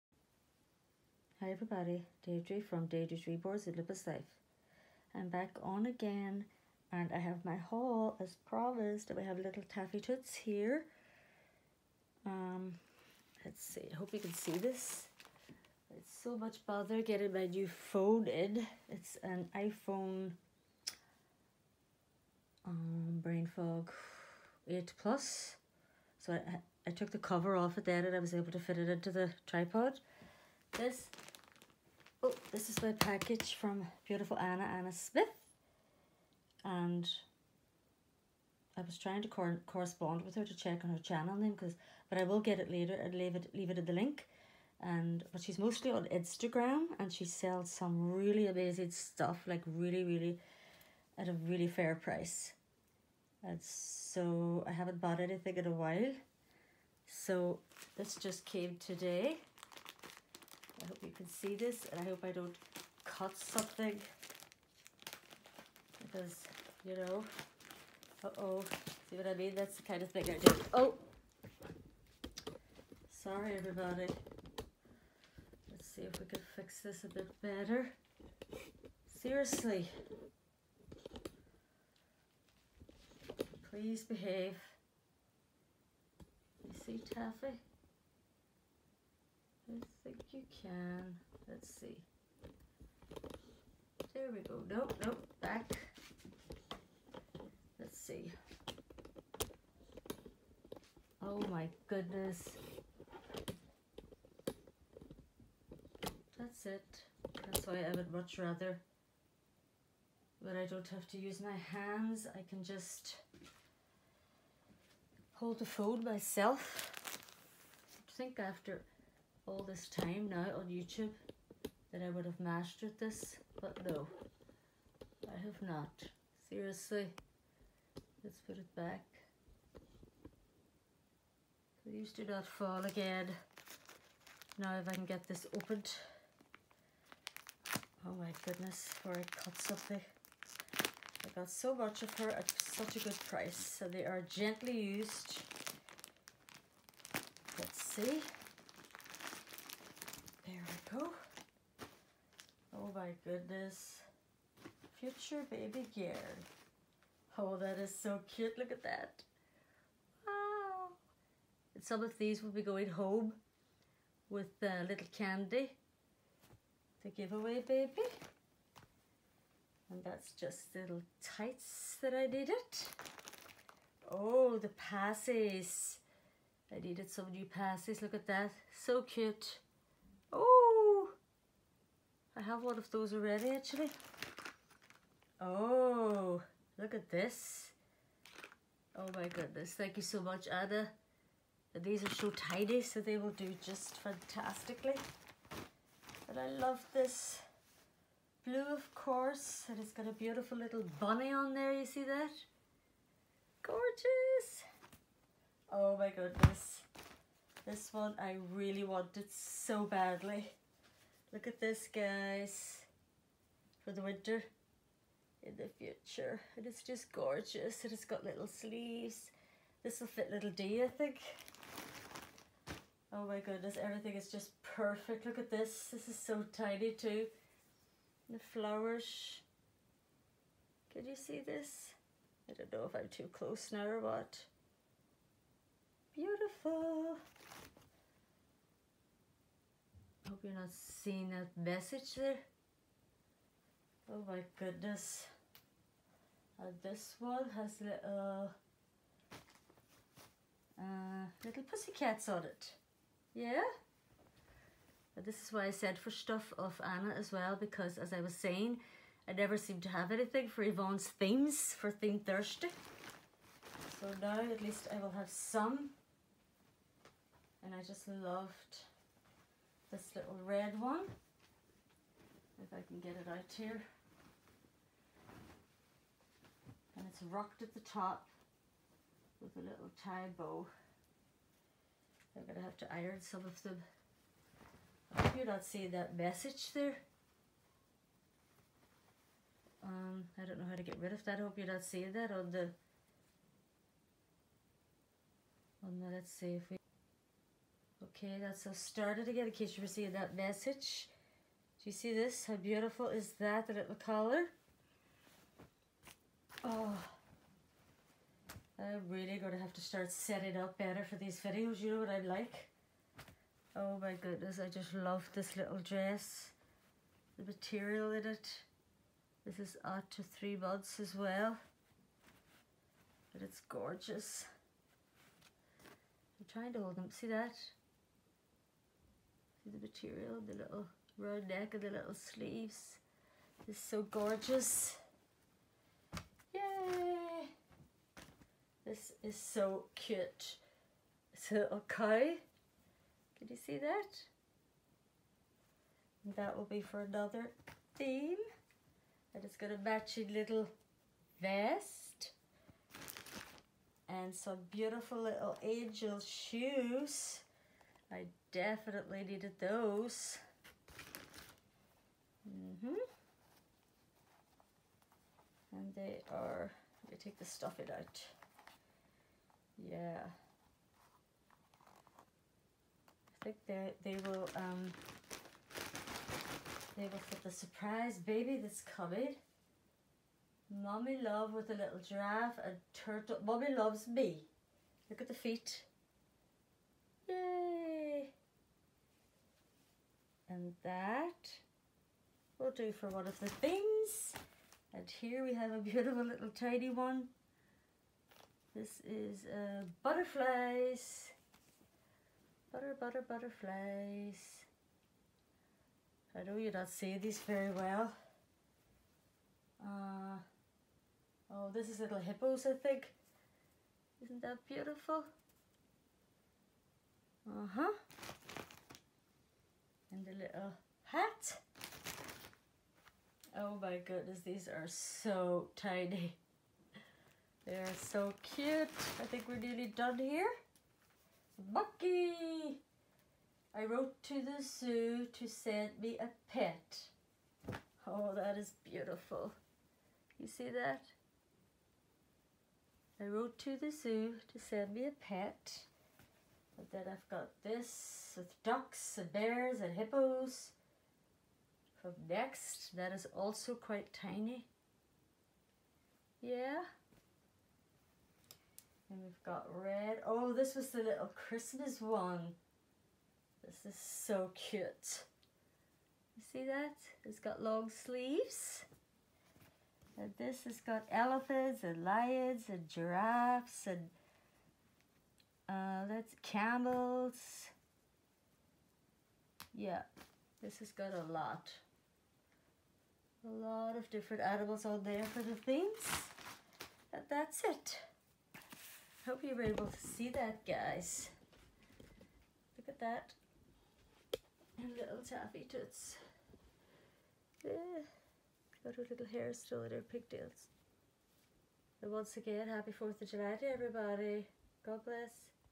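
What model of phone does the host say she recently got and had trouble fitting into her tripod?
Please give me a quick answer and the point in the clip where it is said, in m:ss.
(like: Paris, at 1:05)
iPhone 8 Plus, at 0:19.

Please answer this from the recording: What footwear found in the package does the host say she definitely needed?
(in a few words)
angel shoes.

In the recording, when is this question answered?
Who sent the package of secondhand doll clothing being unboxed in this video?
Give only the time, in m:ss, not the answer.
0:34.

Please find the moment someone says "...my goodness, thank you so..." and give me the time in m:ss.
3:09.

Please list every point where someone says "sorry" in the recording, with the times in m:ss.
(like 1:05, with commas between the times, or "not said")
1:13.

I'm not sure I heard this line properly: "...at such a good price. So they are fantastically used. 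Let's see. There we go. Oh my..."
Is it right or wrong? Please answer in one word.
wrong.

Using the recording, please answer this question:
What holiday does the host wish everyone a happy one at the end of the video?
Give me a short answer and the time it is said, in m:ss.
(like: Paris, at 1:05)
4th of July, at 8:22.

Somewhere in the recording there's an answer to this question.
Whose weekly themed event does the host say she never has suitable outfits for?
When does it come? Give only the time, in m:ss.
4:20.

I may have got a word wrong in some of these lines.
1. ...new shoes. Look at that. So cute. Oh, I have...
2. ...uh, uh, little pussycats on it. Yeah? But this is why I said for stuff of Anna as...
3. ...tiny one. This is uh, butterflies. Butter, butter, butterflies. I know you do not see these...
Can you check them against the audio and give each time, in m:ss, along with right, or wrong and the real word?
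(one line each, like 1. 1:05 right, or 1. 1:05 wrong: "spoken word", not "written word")
1. 2:57 wrong: "passes", not "shoes"
2. 4:07 right
3. 6:36 right.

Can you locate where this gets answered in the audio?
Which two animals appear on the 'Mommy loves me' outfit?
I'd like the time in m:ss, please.
6:22.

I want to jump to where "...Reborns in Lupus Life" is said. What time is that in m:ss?
0:03.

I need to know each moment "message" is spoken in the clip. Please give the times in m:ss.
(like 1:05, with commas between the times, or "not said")
4:01, 4:46, 5:00.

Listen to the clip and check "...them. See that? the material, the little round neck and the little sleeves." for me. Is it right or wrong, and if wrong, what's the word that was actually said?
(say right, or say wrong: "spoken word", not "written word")
right.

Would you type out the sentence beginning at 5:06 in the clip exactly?
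Oh, I'm really going to have to start setting up better for these videos.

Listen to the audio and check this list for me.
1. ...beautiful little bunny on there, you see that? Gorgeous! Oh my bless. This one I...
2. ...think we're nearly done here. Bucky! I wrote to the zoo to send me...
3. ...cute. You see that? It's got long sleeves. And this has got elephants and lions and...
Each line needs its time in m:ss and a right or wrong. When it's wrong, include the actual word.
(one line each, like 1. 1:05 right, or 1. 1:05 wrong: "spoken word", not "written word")
1. 3:20 wrong: "goodness", not "bless"
2. 7:09 right
3. 7:44 right.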